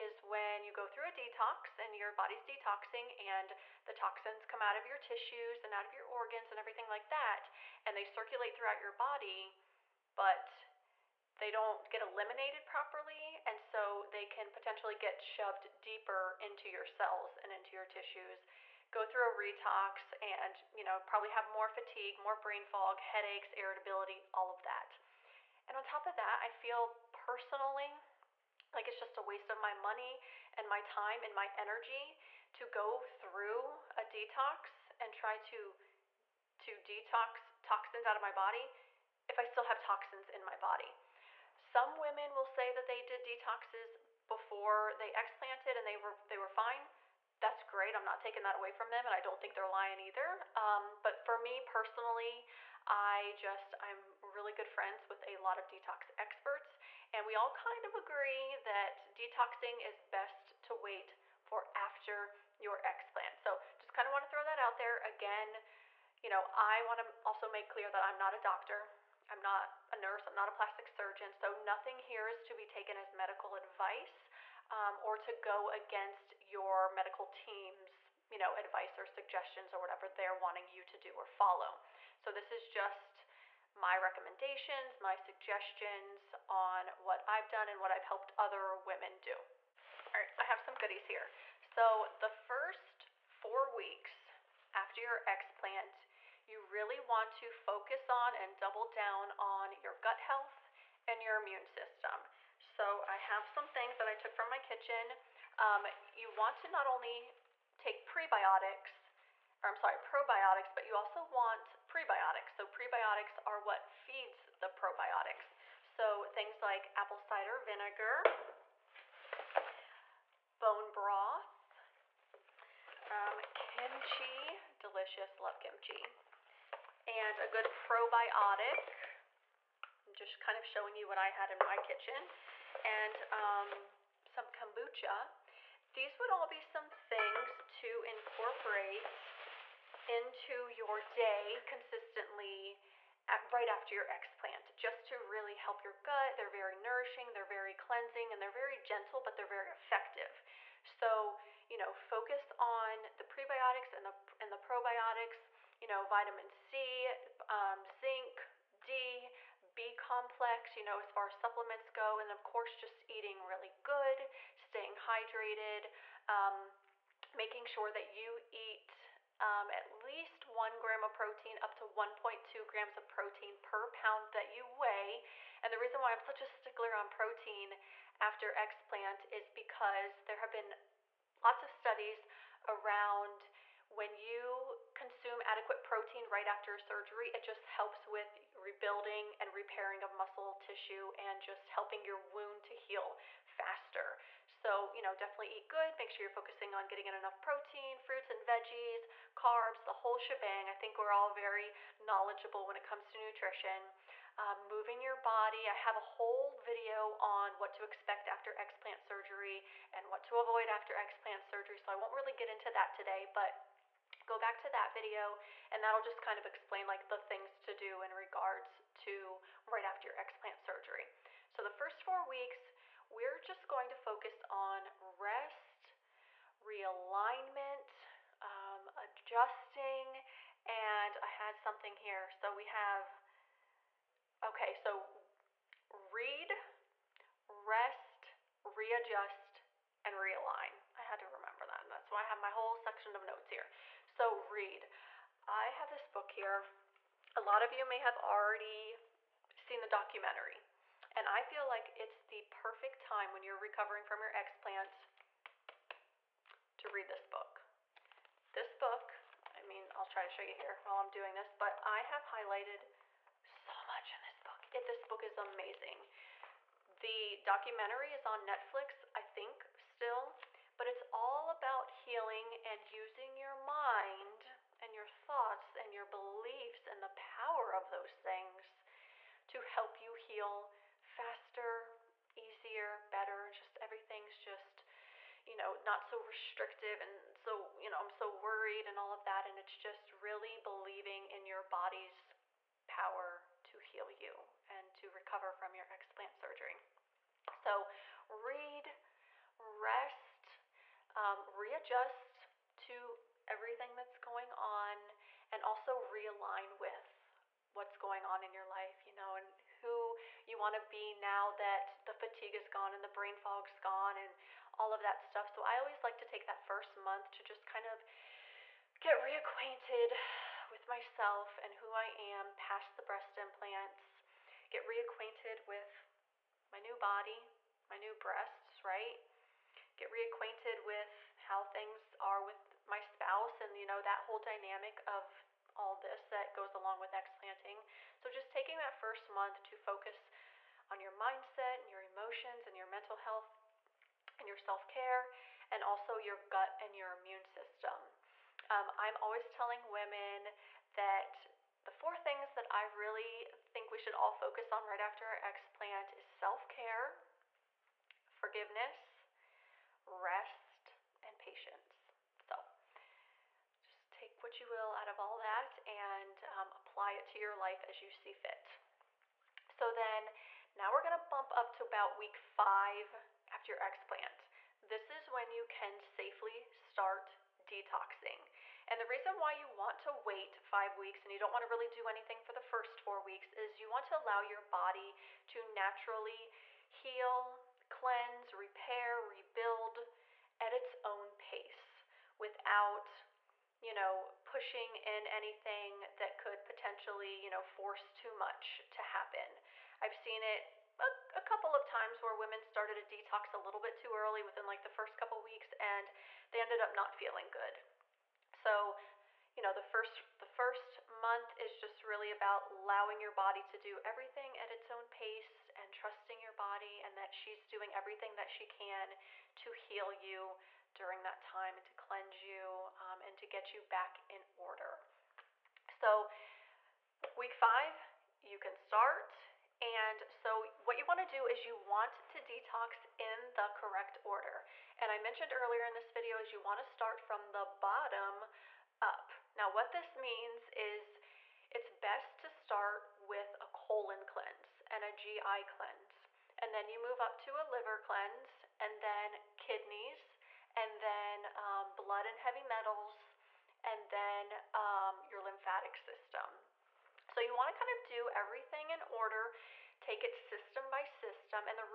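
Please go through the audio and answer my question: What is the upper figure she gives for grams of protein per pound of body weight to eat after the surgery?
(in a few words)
1.2 grams.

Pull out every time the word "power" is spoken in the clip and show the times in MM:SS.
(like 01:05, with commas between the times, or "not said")
04:37, 04:52.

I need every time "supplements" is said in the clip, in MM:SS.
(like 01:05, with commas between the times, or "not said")
02:41.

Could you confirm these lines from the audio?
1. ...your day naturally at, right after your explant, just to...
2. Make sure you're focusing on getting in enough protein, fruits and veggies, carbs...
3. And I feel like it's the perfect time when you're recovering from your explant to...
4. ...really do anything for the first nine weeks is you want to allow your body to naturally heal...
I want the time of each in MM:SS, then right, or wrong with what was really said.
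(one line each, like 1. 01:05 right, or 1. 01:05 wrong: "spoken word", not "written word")
1. 02:20 wrong: "consistently", not "naturally"
2. 03:15 right
3. 04:11 right
4. 06:21 wrong: "four", not "nine".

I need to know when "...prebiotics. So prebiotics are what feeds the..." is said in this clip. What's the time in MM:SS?
01:51.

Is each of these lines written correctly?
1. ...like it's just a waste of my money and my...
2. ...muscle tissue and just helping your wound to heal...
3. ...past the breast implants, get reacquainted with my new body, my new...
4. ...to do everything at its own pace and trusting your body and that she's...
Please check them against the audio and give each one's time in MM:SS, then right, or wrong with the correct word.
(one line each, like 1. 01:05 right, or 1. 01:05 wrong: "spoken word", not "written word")
1. 00:28 right
2. 03:10 right
3. 05:22 right
4. 06:53 right.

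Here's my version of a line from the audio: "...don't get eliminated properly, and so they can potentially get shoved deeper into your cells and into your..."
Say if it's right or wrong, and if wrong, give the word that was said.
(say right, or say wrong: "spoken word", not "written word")
right.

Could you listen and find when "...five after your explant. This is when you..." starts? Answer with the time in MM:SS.
06:12.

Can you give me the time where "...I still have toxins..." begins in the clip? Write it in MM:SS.
00:39.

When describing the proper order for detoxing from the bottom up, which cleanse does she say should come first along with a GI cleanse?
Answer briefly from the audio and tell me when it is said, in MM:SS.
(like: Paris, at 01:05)
colon cleanse, at 07:23.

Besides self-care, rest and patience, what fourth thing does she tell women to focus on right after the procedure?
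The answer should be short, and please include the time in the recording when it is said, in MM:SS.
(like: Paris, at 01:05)
forgiveness, at 05:58.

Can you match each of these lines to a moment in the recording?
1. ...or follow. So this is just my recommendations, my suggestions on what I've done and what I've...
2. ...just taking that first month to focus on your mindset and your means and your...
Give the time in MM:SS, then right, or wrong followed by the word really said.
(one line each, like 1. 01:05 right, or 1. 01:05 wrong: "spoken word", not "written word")
1. 01:21 right
2. 05:38 wrong: "emotions", not "means".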